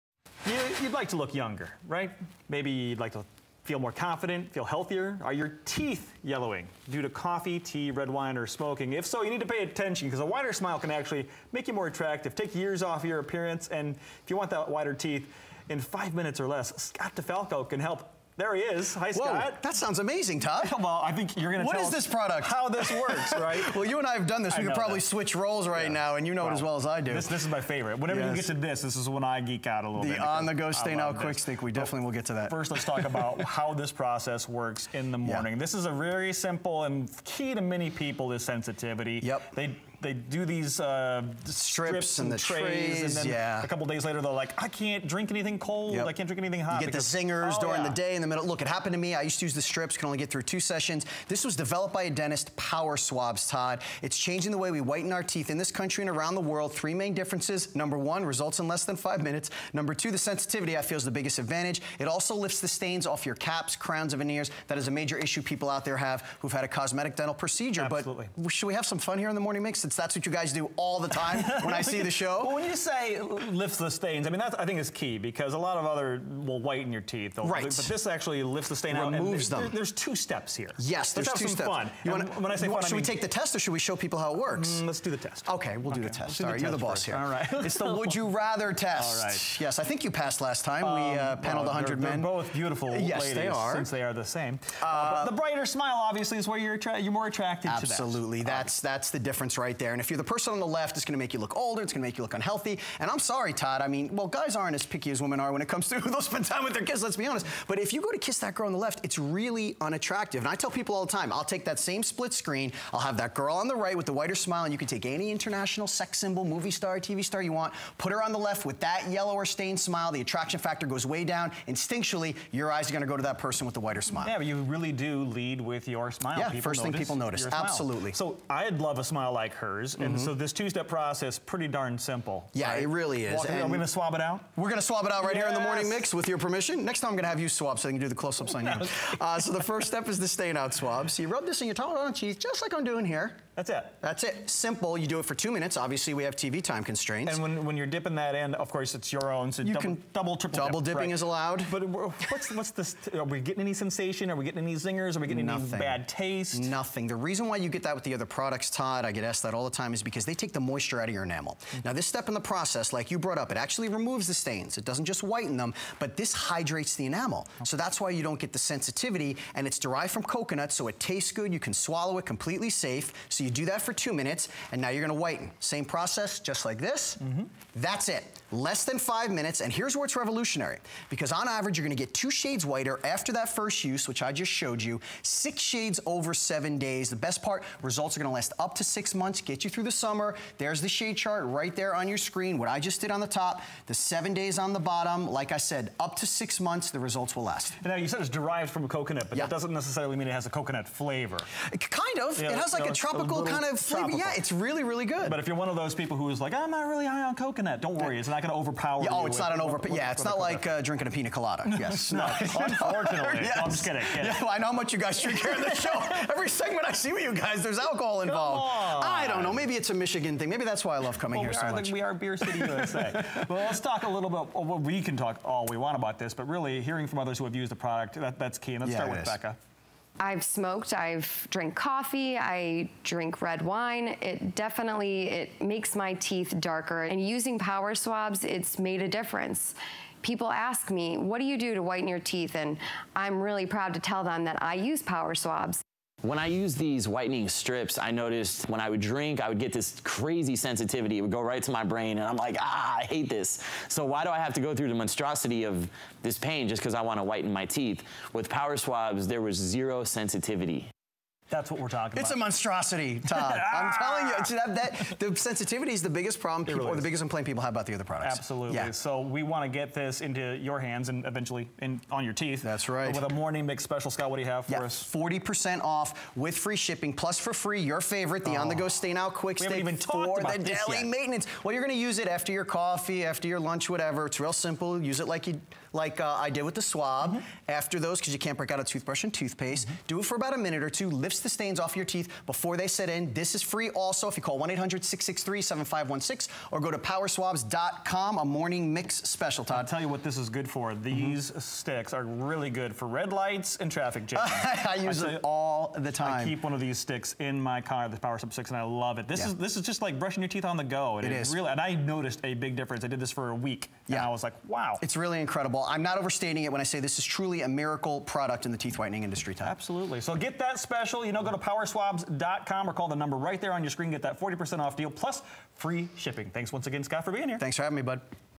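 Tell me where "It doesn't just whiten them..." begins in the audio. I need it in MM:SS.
02:44.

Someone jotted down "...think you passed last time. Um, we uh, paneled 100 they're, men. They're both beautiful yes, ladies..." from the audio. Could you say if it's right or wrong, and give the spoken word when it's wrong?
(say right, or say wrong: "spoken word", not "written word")
right.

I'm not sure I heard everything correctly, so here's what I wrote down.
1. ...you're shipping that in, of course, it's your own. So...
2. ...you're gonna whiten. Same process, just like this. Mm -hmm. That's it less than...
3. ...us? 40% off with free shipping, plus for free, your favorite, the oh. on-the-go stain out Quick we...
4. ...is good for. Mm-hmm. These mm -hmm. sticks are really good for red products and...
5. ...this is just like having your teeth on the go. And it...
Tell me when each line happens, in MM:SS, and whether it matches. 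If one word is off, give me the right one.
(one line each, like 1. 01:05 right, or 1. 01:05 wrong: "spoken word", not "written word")
1. 02:27 wrong: "dipping", not "shipping"
2. 02:54 right
3. 04:34 right
4. 05:00 wrong: "lights", not "products"
5. 05:09 wrong: "brushing", not "having".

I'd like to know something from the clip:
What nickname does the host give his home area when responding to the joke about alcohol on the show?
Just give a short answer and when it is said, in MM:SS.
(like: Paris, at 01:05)
Beer City USA, at 03:42.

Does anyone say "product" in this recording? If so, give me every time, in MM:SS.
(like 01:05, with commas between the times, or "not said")
00:22, 02:38, 03:47, 04:28, 05:18.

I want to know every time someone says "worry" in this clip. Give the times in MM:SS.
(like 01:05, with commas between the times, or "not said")
03:27.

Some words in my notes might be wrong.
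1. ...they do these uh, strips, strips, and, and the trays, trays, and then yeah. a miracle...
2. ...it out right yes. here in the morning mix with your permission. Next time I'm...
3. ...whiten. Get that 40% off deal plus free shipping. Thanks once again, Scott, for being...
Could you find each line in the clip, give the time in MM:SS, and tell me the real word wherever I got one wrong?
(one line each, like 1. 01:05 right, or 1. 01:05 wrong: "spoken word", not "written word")
1. 00:40 wrong: "couple", not "miracle"
2. 02:15 right
3. 05:23 wrong: "screen", not "whiten".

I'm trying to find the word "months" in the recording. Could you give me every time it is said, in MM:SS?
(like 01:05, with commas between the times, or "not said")
03:09, 03:16.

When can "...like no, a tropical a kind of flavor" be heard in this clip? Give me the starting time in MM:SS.
03:22.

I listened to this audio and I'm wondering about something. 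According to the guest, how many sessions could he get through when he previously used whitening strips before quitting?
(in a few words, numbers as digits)
2.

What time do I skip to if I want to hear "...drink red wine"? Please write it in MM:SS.
03:53.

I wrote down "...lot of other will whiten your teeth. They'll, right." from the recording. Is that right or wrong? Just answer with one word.
right.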